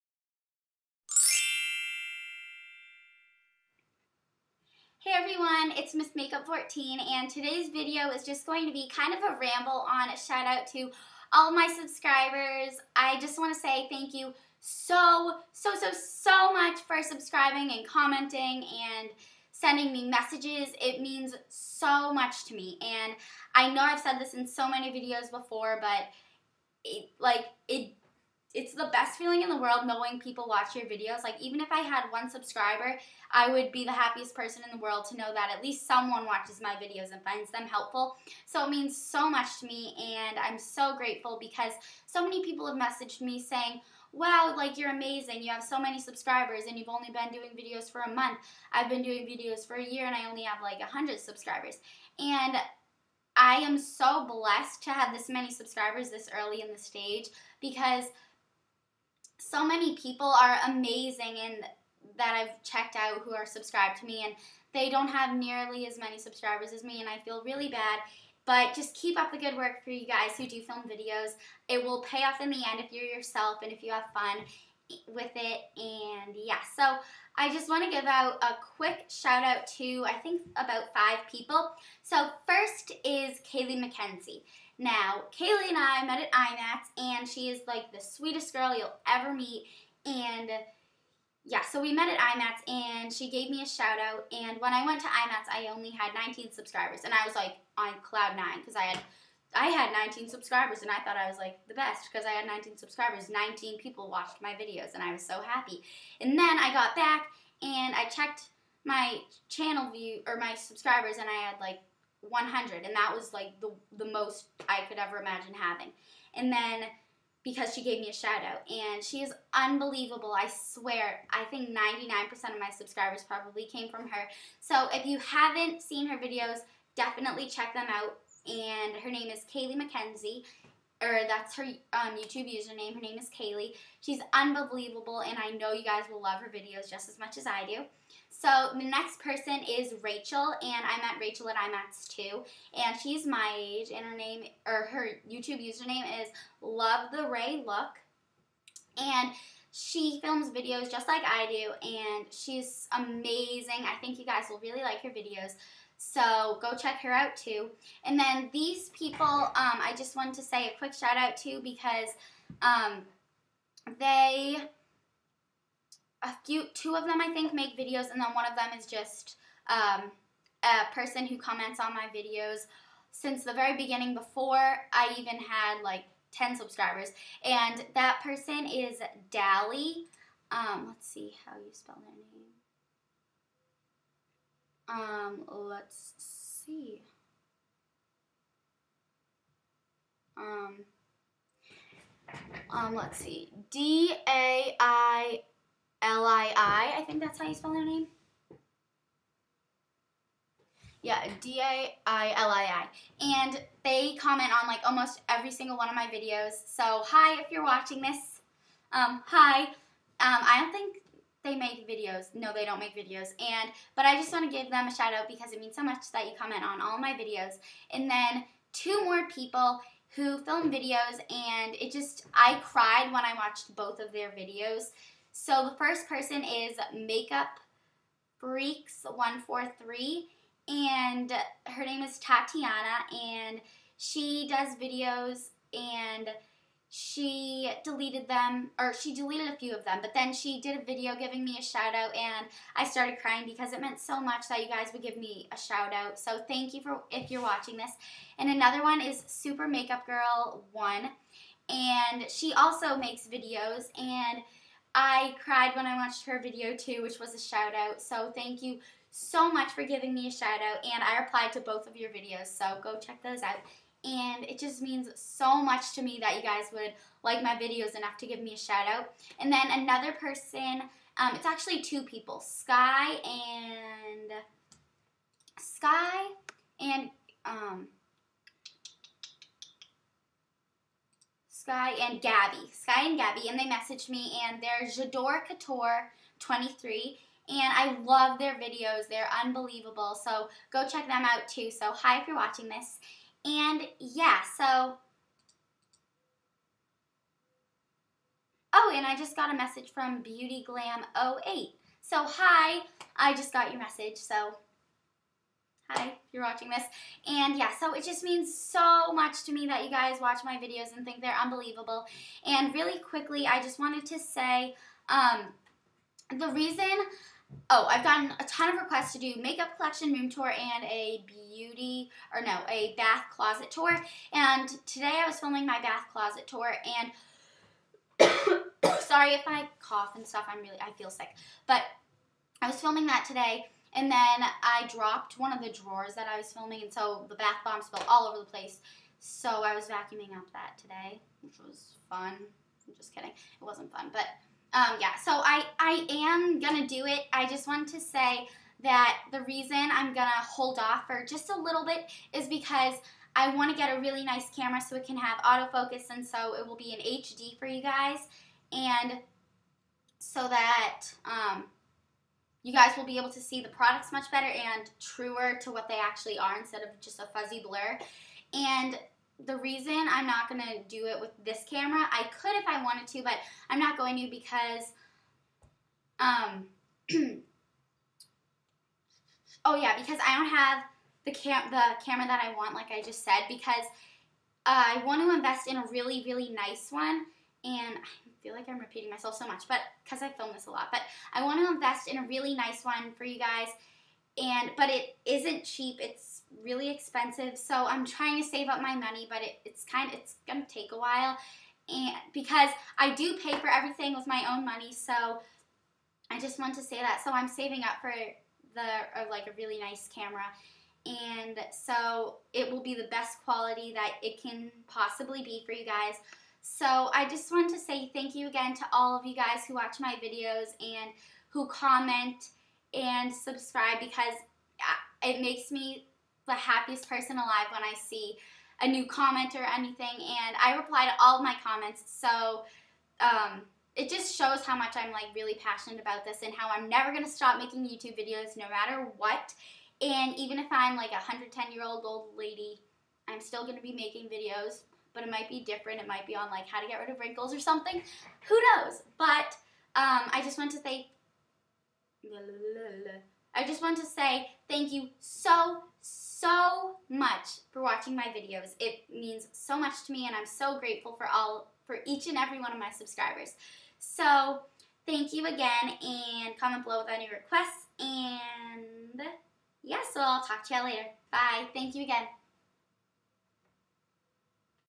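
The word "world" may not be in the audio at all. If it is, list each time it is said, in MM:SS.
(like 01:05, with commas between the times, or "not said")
00:29, 00:34.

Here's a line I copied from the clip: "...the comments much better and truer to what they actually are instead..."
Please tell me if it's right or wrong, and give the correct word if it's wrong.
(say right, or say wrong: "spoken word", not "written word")
wrong: "products", not "comments".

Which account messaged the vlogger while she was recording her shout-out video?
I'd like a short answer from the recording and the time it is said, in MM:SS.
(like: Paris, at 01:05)
Beauty Glam 08, at 05:00.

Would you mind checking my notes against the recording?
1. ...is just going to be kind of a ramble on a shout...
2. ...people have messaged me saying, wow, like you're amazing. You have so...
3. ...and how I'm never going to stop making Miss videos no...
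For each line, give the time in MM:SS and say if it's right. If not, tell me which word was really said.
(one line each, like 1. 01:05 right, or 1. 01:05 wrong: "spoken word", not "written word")
1. 00:08 right
2. 00:42 right
3. 07:16 wrong: "YouTube", not "Miss".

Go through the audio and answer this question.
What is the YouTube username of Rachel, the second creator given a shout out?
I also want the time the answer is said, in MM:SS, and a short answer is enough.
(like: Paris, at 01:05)
Love the Ray Look, at 02:26.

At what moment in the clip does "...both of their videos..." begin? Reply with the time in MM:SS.
03:43.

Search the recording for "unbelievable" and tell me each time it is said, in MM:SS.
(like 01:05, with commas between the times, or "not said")
01:59, 02:14, 04:49, 05:11.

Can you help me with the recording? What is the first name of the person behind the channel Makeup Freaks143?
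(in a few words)
Tatiana.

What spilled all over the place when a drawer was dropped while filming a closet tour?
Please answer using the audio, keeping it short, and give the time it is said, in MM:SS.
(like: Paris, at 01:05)
bath bombs, at 05:37.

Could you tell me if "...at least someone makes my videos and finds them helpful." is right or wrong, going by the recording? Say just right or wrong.
wrong.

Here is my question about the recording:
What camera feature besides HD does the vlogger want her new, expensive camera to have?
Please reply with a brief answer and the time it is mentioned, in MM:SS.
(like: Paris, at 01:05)
autofocus, at 05:55.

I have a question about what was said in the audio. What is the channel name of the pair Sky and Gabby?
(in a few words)
Jador Couture 23.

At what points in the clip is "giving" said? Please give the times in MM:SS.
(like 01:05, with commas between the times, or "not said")
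04:01, 04:19.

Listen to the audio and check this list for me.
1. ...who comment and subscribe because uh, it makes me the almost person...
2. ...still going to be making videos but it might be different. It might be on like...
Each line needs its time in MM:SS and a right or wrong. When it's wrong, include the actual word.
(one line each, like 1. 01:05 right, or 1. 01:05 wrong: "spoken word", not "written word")
1. 07:01 wrong: "happiest", not "almost"
2. 07:23 right.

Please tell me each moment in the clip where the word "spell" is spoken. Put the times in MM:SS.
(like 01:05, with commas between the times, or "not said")
03:01, 03:17.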